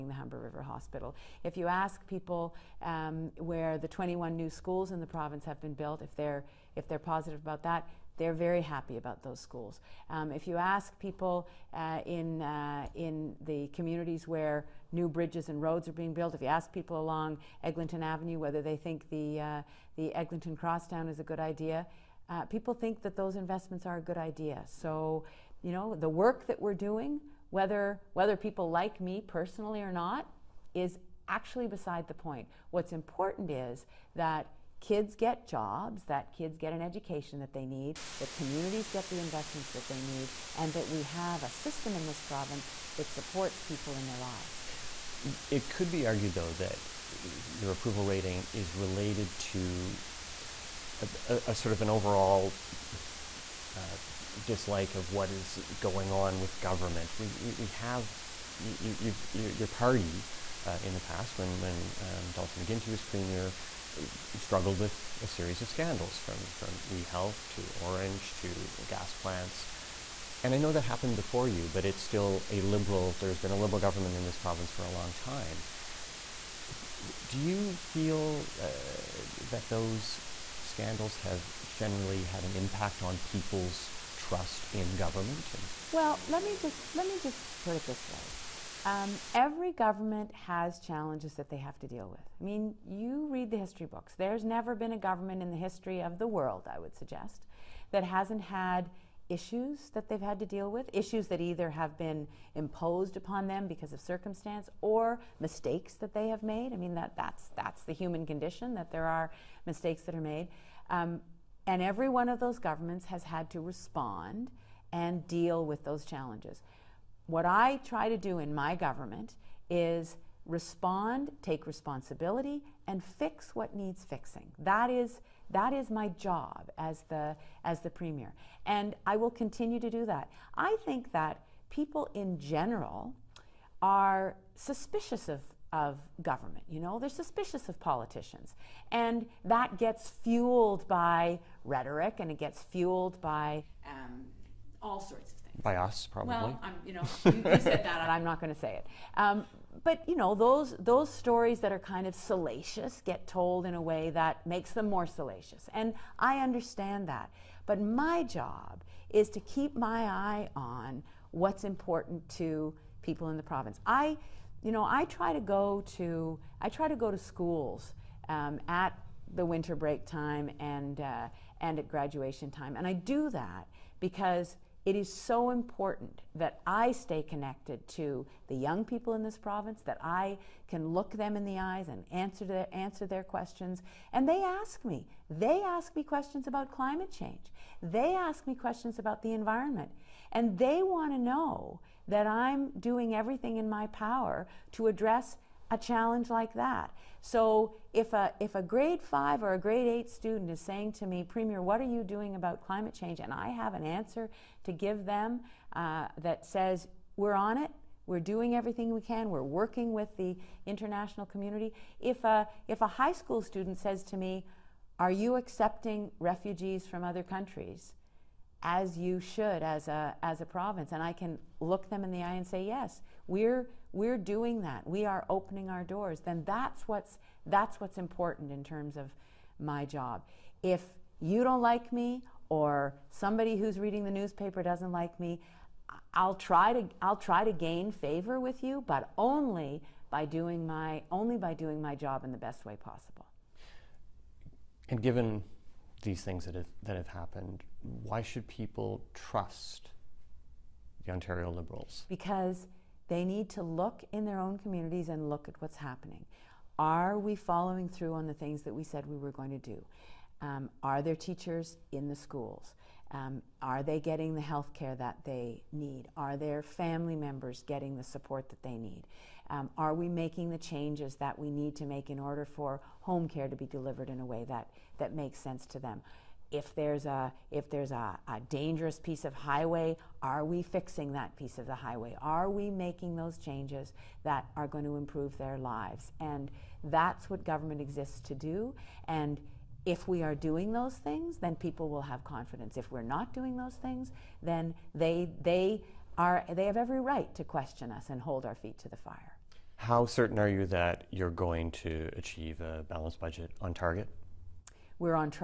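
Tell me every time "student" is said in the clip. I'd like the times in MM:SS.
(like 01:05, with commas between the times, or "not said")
03:20, 03:33.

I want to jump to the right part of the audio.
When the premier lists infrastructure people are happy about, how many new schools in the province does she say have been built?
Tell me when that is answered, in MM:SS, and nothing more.
00:03.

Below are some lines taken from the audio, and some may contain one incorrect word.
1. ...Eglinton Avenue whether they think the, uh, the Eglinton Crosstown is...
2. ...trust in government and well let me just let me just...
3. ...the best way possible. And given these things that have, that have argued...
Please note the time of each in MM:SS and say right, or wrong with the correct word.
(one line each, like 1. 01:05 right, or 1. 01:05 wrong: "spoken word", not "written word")
1. 00:17 right
2. 01:24 right
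3. 04:02 wrong: "happened", not "argued".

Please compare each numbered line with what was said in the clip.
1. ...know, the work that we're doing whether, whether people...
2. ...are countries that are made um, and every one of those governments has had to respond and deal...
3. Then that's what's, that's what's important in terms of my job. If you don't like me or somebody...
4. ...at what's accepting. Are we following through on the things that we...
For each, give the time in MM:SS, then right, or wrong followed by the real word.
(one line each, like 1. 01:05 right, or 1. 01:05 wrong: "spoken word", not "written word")
1. 00:25 right
2. 01:49 wrong: "mistakes", not "countries"
3. 03:46 right
4. 04:15 wrong: "happening", not "accepting".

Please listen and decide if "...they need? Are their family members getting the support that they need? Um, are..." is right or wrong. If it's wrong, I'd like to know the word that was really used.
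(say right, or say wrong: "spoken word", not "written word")
right.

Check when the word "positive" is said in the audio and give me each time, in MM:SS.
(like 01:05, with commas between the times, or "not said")
00:06.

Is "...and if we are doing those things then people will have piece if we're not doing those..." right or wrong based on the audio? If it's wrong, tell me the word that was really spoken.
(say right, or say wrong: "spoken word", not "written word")
wrong: "confidence", not "piece".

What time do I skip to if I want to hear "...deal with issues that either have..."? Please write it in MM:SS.
01:40.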